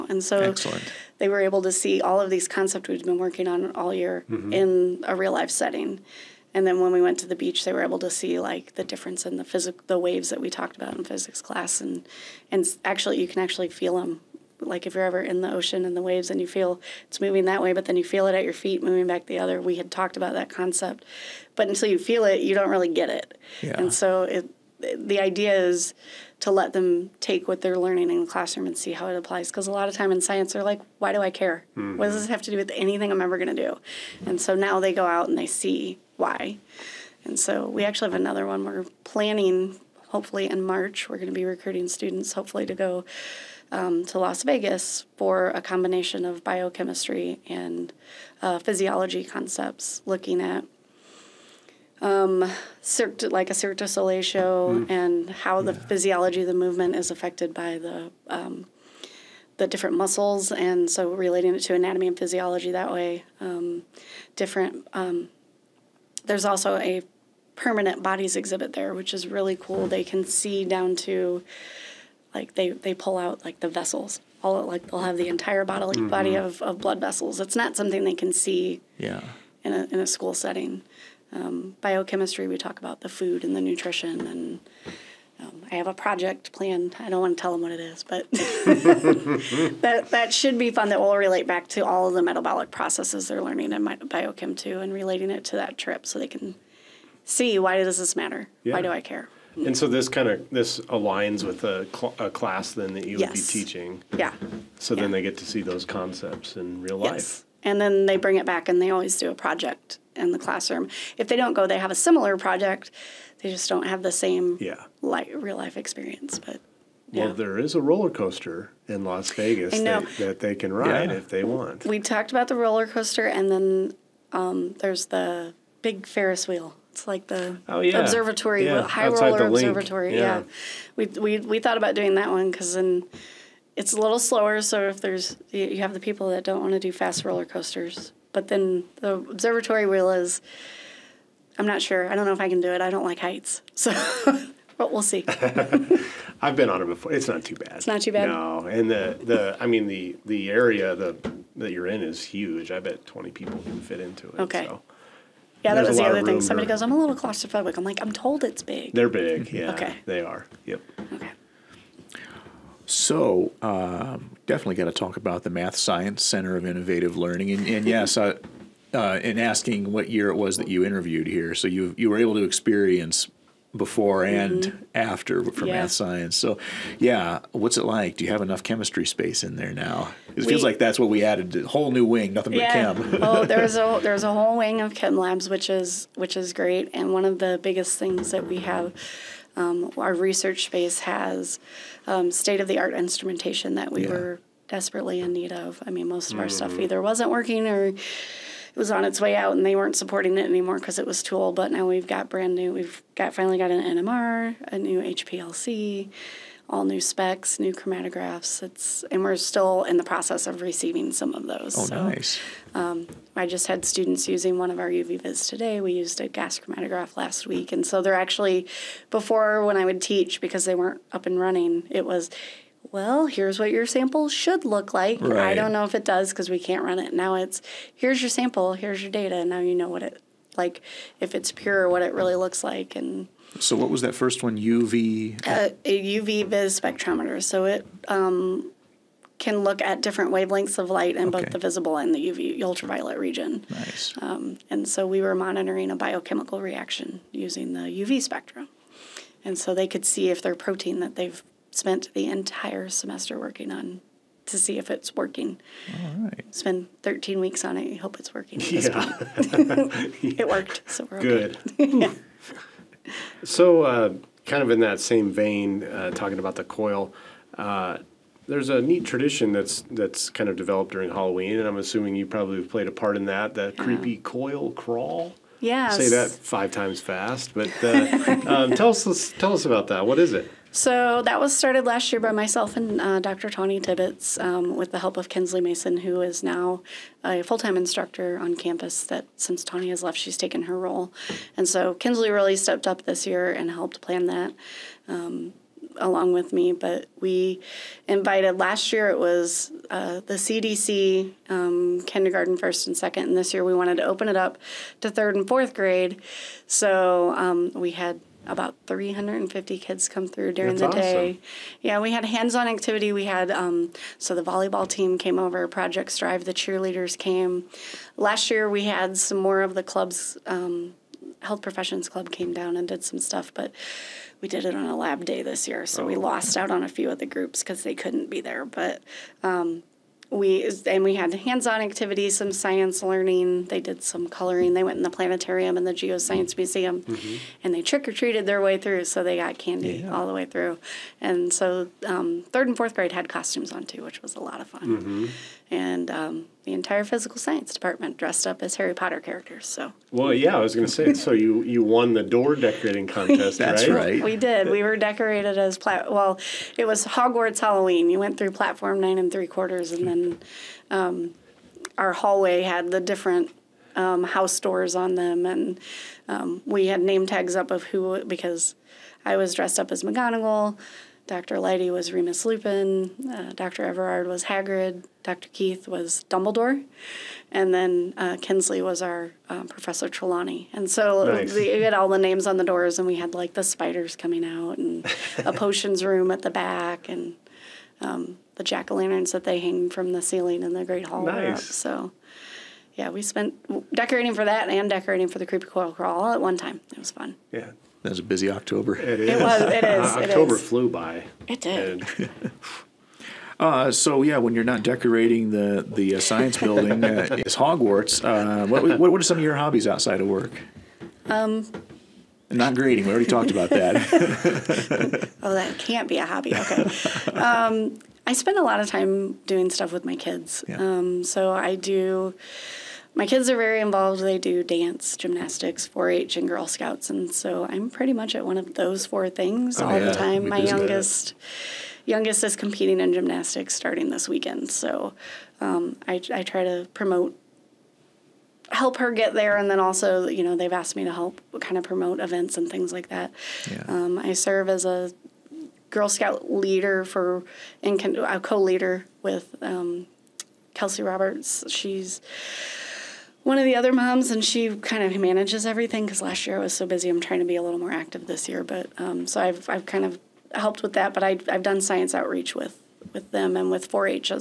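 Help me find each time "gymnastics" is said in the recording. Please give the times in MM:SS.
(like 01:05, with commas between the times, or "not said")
07:05, 07:13.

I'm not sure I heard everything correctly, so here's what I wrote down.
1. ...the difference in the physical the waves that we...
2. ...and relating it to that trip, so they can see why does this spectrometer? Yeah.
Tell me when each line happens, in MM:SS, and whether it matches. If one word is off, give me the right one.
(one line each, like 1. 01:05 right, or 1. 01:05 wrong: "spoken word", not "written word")
1. 00:08 right
2. 01:34 wrong: "matter", not "spectrometer".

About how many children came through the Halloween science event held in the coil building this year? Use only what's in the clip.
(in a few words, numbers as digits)
350.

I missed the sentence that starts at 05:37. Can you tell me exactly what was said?
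and they trick or treated their way through.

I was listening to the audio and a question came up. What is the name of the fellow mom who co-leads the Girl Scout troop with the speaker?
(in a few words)
Kelsey Roberts.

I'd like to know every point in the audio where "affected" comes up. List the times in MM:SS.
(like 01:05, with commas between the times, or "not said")
00:57.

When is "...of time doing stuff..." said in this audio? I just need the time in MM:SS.
06:58.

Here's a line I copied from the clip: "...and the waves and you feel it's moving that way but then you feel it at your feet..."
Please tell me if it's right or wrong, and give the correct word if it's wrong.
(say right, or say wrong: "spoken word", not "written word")
right.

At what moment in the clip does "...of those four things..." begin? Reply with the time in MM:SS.
07:08.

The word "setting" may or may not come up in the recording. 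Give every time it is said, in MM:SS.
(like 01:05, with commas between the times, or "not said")
00:05, 01:20.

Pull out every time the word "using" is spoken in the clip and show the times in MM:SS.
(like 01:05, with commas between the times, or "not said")
03:34, 04:07.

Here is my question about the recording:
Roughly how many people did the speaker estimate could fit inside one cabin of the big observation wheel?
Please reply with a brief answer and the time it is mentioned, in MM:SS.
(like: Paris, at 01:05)
20, at 02:33.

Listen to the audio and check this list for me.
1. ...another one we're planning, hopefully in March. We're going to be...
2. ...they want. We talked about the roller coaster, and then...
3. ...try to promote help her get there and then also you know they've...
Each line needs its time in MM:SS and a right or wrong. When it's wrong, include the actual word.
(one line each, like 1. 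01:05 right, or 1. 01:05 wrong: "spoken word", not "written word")
1. 00:38 right
2. 02:01 right
3. 07:16 right.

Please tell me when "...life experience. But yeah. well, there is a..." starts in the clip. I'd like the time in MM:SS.
01:55.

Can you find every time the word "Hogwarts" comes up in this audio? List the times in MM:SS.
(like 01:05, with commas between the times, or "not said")
05:57, 06:47.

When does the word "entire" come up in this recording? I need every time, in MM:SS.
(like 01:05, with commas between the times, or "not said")
01:15, 04:12, 05:46.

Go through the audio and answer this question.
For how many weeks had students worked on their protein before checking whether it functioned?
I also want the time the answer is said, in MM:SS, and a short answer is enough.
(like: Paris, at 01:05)
13, at 04:17.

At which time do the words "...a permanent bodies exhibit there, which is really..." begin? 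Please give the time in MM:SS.
01:06.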